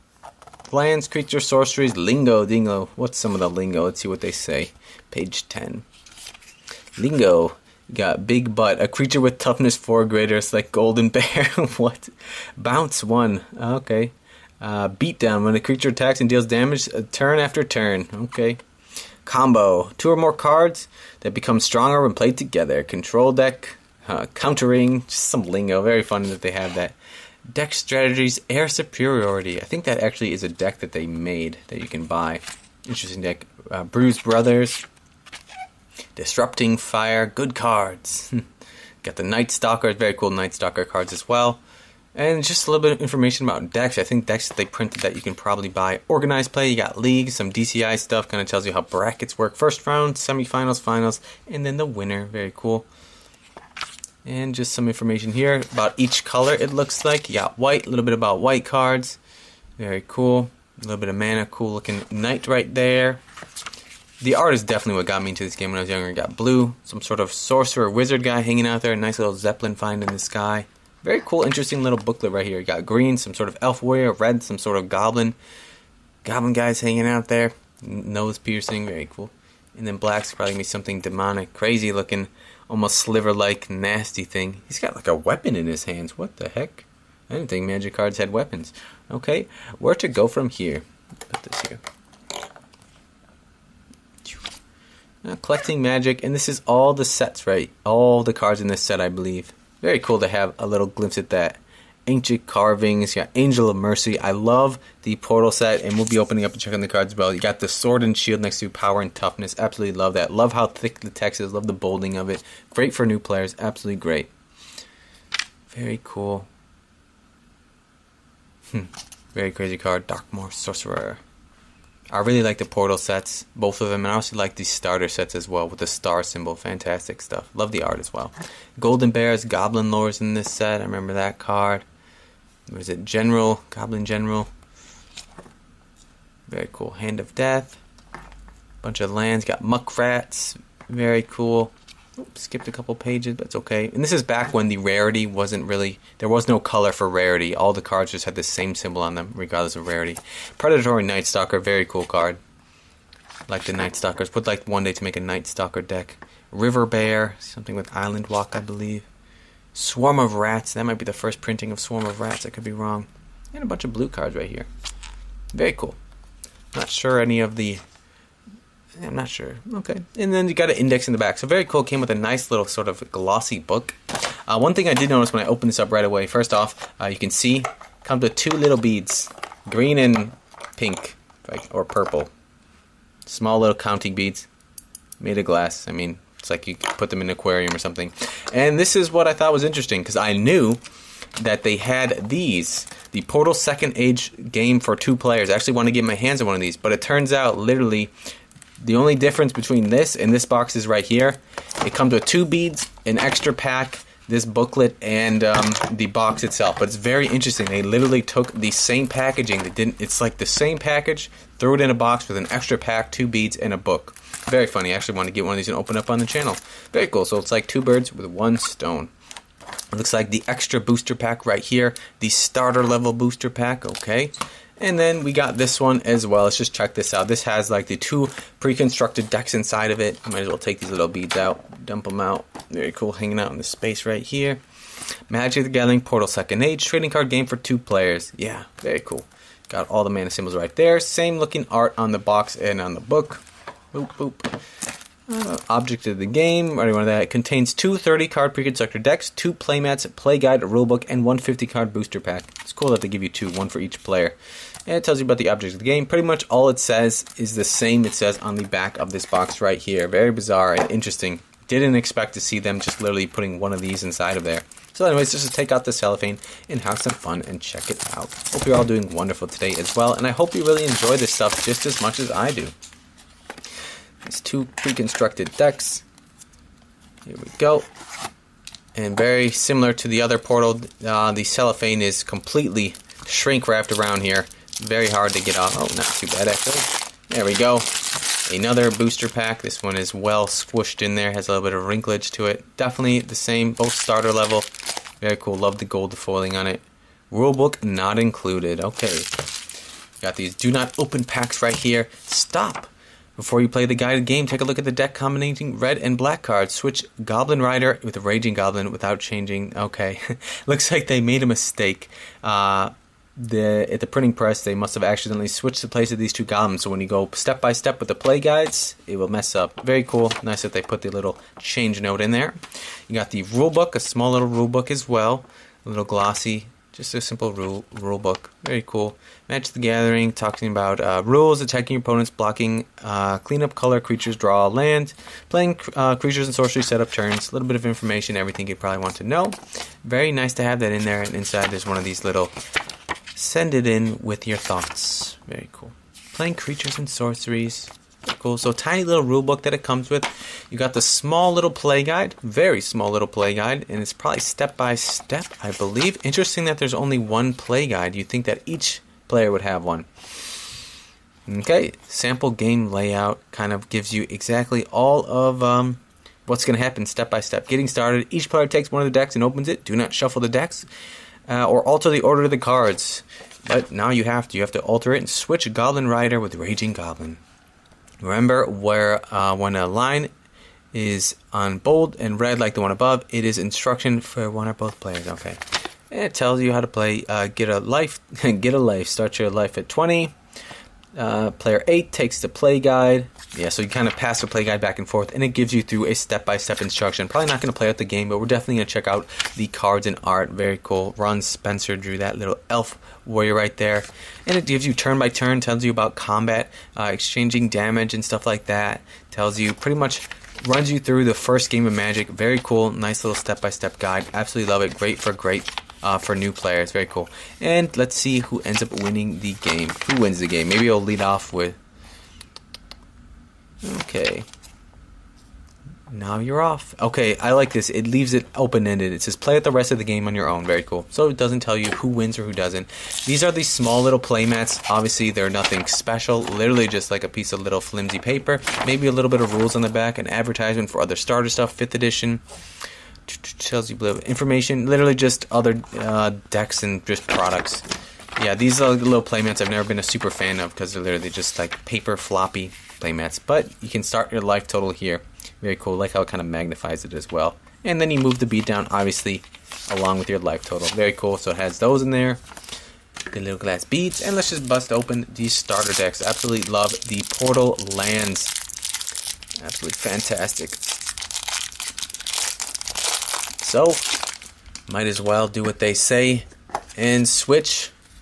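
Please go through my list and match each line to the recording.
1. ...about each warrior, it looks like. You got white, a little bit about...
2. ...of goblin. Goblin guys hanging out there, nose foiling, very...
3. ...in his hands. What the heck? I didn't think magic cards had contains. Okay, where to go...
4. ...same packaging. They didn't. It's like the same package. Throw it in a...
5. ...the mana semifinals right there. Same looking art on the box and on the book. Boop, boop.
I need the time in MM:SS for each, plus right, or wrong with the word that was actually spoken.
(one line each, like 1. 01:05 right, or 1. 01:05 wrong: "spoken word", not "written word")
1. 00:55 wrong: "color", not "warrior"
2. 01:14 wrong: "piercing", not "foiling"
3. 01:25 wrong: "weapons", not "contains"
4. 03:28 right
5. 04:00 wrong: "symbols", not "semifinals".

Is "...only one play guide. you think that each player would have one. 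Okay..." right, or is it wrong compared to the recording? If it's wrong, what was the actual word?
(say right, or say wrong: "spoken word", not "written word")
right.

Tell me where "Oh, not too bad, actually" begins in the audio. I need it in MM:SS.
04:45.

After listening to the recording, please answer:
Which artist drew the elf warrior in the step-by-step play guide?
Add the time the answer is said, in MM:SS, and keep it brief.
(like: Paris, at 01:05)
Ron Spencer, at 06:41.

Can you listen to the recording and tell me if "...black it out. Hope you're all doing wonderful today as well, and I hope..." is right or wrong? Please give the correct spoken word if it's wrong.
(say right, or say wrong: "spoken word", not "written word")
wrong: "check", not "black".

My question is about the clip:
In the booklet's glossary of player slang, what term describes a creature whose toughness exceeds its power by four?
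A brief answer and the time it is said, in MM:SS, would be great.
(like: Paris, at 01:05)
Big Butt, at 00:08.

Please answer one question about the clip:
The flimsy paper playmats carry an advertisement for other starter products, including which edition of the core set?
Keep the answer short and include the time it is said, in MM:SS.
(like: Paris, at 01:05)
5th edition, at 07:21.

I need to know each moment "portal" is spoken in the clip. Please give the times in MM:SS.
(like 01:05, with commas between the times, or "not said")
01:45, 02:02, 03:13, 03:56, 04:40, 07:47.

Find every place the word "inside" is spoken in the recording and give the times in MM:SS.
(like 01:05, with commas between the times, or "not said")
03:49, 04:24, 05:41.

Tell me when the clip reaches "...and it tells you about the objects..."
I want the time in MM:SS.
04:14.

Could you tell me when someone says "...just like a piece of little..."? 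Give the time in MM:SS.
07:16.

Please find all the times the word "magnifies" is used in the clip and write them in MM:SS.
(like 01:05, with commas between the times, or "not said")
07:36.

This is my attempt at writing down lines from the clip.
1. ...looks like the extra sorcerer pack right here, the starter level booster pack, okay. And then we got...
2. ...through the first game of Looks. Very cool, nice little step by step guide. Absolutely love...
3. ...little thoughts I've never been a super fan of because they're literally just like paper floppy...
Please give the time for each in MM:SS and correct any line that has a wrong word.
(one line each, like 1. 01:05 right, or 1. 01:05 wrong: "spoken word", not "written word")
1. 03:39 wrong: "booster", not "sorcerer"
2. 06:50 wrong: "Magic", not "Looks"
3. 07:28 wrong: "playmats", not "thoughts".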